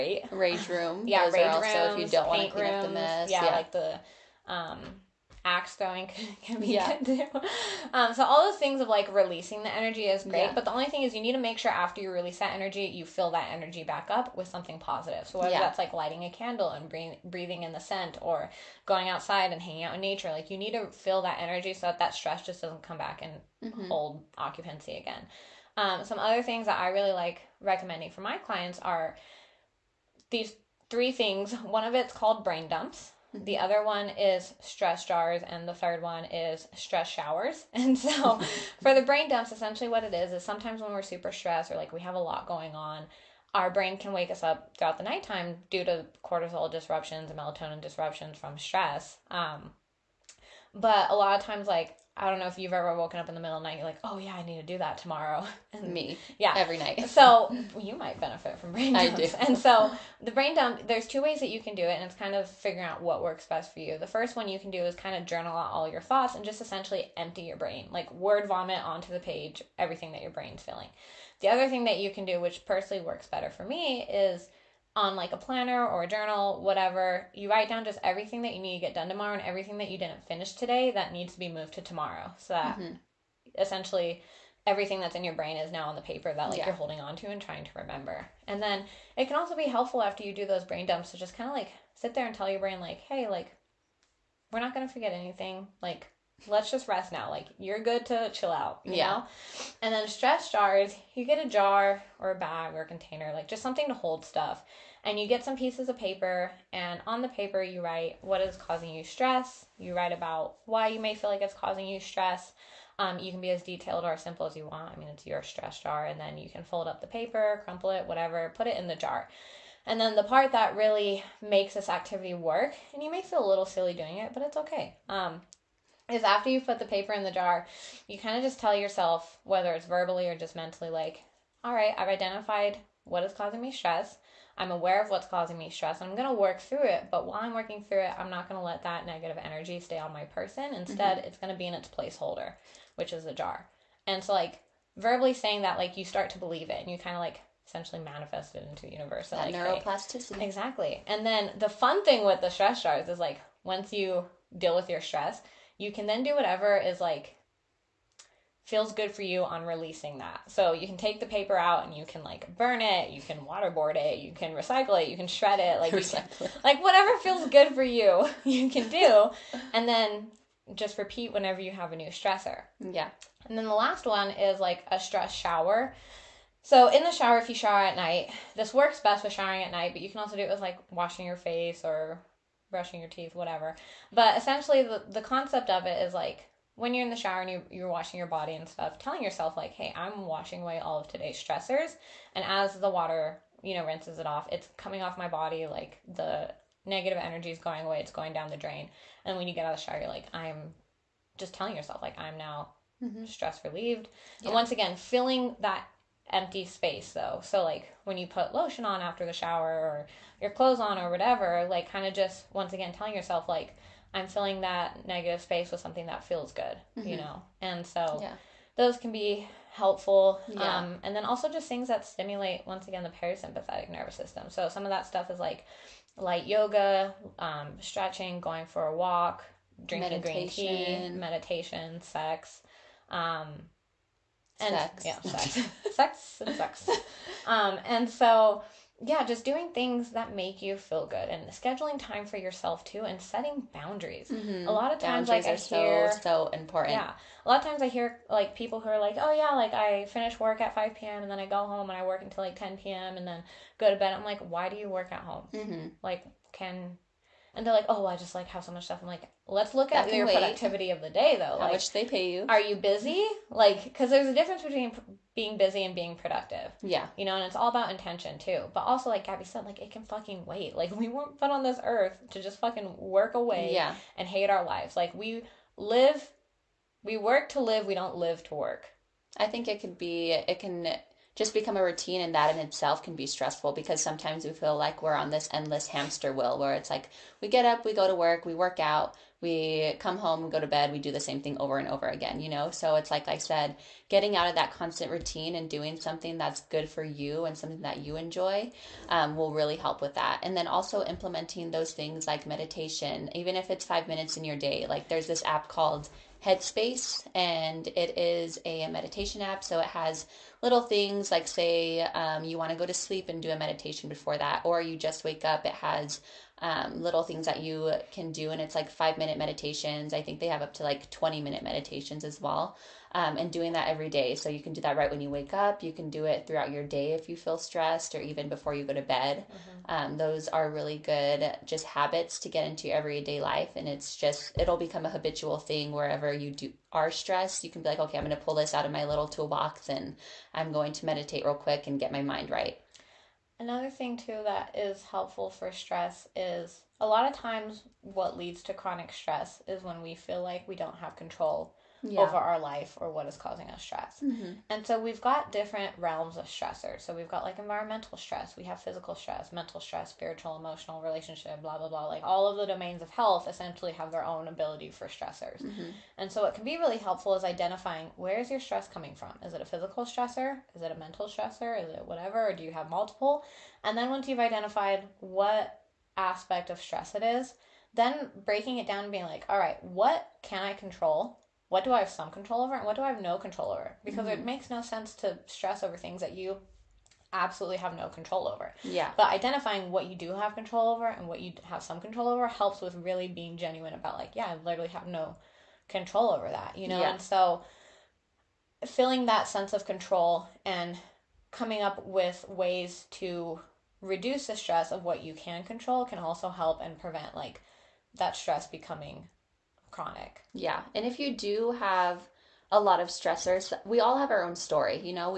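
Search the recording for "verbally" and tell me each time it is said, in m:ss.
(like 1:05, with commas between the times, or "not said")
2:09, 2:24.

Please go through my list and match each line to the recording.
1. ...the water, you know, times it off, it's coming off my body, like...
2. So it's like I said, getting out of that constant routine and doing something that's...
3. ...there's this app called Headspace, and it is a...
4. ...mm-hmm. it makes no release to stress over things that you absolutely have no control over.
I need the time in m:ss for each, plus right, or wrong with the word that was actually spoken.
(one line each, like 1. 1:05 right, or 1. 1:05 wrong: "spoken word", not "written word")
1. 3:12 wrong: "rinses", not "times"
2. 4:52 right
3. 5:05 right
4. 6:24 wrong: "sense", not "release".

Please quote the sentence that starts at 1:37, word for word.
Like you're good to chill out.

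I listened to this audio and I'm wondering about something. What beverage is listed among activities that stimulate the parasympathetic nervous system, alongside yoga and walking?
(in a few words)
green tea.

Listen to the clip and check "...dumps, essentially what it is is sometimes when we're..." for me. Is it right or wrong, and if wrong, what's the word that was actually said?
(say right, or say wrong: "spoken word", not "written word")
right.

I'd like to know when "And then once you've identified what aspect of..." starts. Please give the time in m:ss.
6:13.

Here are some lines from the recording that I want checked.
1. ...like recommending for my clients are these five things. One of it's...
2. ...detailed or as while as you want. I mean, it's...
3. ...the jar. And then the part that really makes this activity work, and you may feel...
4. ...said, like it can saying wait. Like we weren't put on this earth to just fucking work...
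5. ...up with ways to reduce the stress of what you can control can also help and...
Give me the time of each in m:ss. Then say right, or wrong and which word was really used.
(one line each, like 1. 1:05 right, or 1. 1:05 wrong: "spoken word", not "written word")
1. 0:27 wrong: "three", not "five"
2. 1:53 wrong: "simple", not "while"
3. 1:58 right
4. 4:29 wrong: "fucking", not "saying"
5. 6:41 right.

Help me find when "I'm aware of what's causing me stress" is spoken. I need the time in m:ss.
2:14.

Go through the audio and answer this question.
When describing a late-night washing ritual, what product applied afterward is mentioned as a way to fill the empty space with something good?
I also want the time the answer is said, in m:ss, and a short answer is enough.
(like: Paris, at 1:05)
lotion, at 3:28.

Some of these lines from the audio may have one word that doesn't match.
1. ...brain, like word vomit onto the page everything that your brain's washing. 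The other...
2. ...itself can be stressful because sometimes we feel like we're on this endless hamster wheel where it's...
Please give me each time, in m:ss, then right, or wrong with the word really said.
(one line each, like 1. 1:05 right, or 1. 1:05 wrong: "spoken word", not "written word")
1. 1:07 wrong: "feeling", not "washing"
2. 4:42 right.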